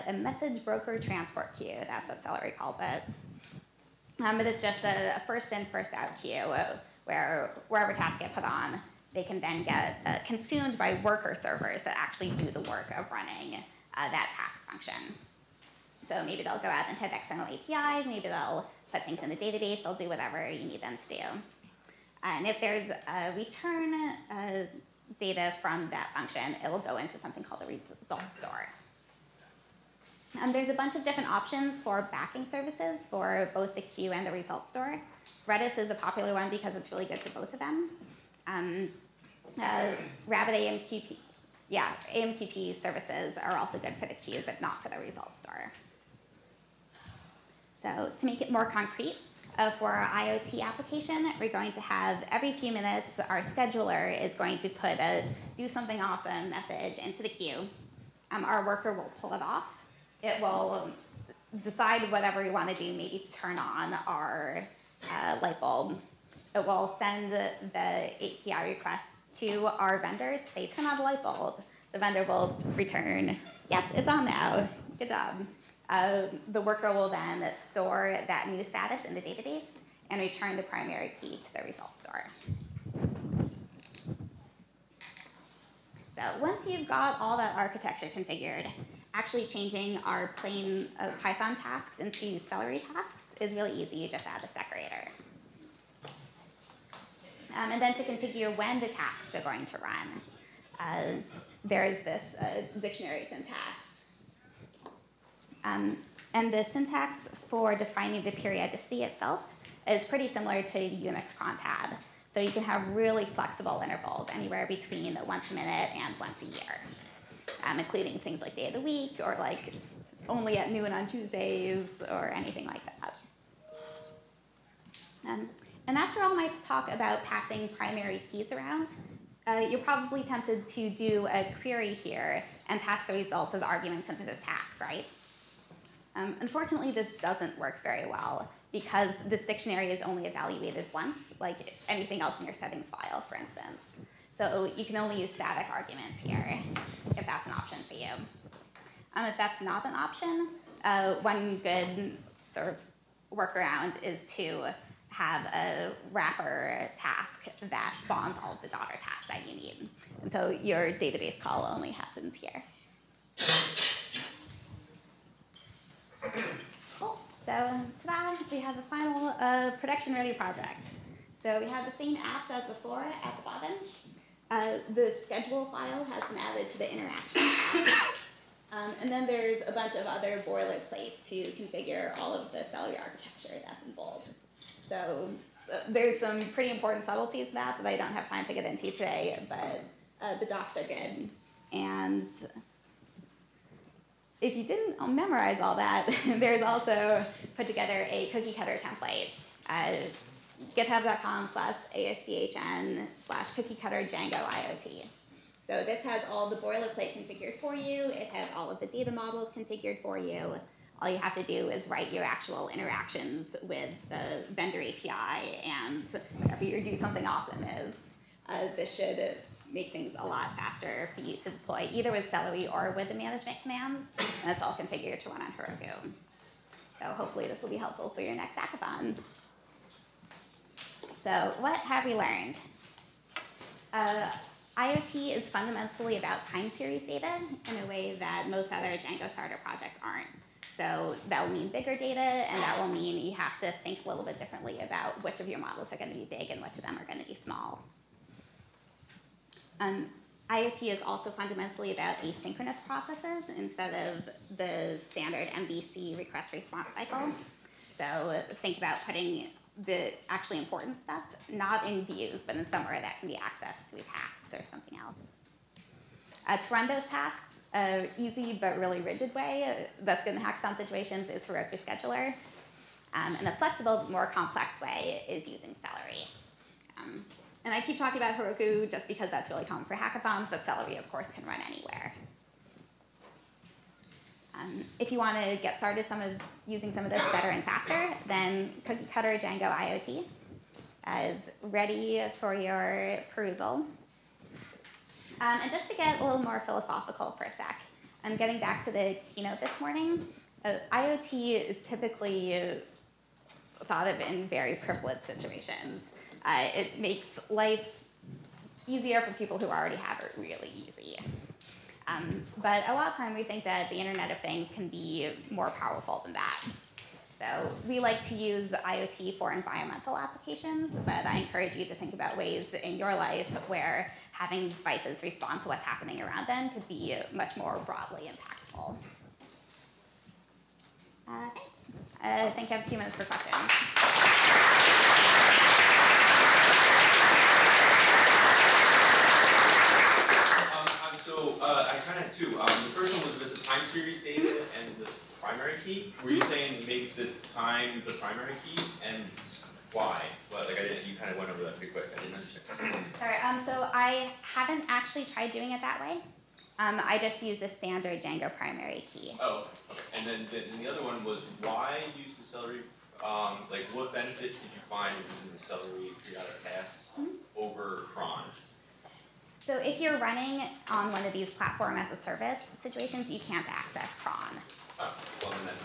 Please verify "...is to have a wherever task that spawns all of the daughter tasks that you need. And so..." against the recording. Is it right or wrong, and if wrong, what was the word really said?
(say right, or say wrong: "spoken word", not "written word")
wrong: "wrapper", not "wherever".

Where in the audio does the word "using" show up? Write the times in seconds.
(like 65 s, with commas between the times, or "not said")
275 s, 286 s, 365 s.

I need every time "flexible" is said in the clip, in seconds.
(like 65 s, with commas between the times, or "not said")
113 s, 273 s.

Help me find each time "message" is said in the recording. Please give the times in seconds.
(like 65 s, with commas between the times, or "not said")
0 s, 56 s.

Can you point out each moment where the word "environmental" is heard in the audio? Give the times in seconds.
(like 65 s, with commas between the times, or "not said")
319 s.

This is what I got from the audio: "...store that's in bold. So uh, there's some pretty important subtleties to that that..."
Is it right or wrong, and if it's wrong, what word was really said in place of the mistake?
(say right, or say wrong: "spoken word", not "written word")
wrong: "architecture", not "store".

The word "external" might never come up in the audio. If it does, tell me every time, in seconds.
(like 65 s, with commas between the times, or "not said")
17 s.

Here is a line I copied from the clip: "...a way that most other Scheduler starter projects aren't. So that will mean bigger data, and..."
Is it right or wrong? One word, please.
wrong.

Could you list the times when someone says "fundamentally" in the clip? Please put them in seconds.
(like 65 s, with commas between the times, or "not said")
235 s, 251 s.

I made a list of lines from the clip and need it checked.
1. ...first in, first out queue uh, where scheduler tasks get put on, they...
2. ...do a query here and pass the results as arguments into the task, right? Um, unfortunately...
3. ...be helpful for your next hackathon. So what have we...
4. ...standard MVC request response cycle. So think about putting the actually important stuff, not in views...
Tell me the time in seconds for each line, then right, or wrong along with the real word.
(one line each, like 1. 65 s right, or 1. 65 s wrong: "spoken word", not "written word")
1. 5 s wrong: "wherever", not "scheduler"
2. 130 s right
3. 227 s right
4. 255 s right.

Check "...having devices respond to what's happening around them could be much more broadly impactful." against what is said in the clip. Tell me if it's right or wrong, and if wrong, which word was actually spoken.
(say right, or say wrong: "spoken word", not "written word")
right.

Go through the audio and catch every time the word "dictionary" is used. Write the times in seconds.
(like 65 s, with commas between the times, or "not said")
102 s, 139 s.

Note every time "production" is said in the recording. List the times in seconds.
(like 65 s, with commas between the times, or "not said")
169 s.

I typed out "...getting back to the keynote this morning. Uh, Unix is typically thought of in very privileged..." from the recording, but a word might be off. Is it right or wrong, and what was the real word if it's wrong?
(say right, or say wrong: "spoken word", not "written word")
wrong: "IoT", not "Unix".